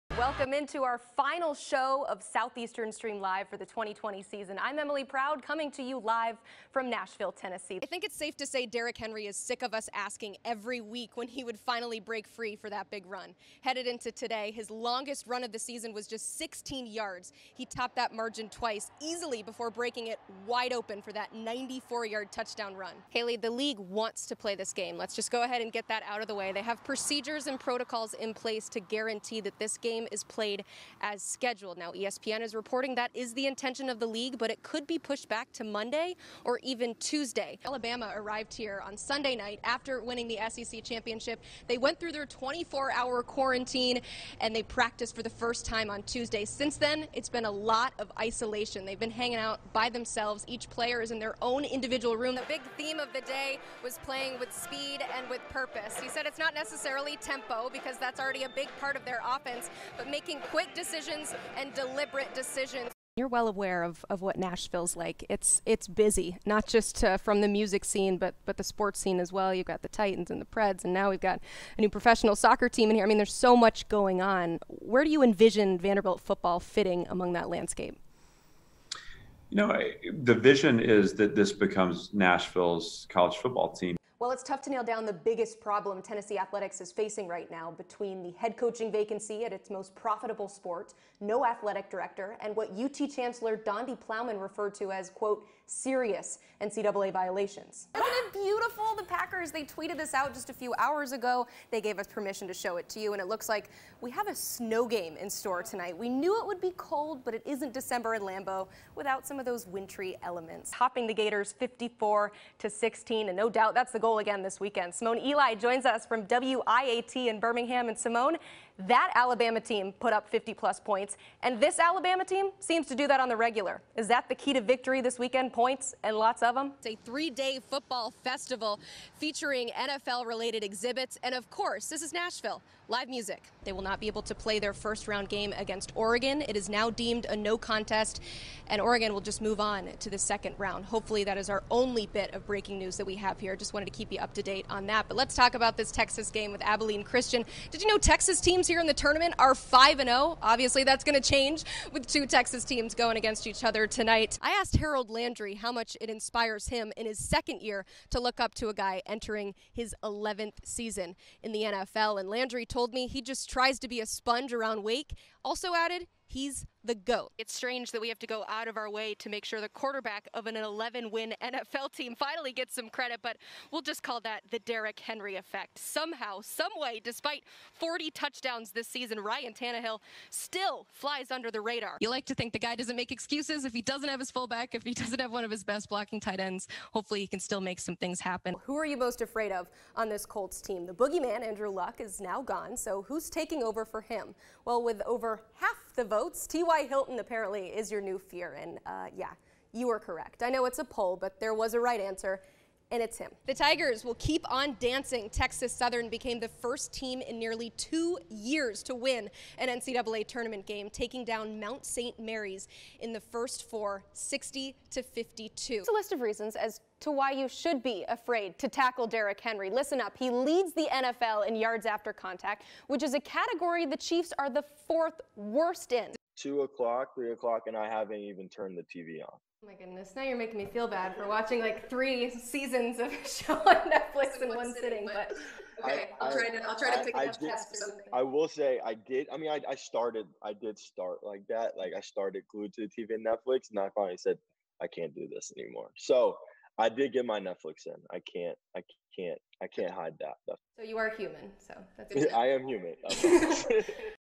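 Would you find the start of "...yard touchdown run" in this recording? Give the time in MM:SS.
00:22.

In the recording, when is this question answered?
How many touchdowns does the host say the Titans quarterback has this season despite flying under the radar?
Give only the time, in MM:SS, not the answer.
02:57.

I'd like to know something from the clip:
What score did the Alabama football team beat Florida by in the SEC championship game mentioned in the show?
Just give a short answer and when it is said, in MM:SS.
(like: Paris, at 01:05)
54 to 16, at 01:51.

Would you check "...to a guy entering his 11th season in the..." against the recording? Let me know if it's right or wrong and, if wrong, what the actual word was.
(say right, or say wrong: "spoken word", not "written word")
right.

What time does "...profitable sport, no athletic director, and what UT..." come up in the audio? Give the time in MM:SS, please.
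01:29.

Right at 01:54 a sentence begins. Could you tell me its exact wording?
Simone Eli joins us from WIAT in Birmingham.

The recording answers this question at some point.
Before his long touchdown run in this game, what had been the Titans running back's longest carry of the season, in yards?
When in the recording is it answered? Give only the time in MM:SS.
00:16.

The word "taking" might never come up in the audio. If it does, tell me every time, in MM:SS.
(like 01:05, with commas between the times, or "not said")
03:13, 03:30.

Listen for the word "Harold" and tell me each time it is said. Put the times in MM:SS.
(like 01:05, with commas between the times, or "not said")
02:34.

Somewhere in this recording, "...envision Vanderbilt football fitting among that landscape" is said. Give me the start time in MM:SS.
01:15.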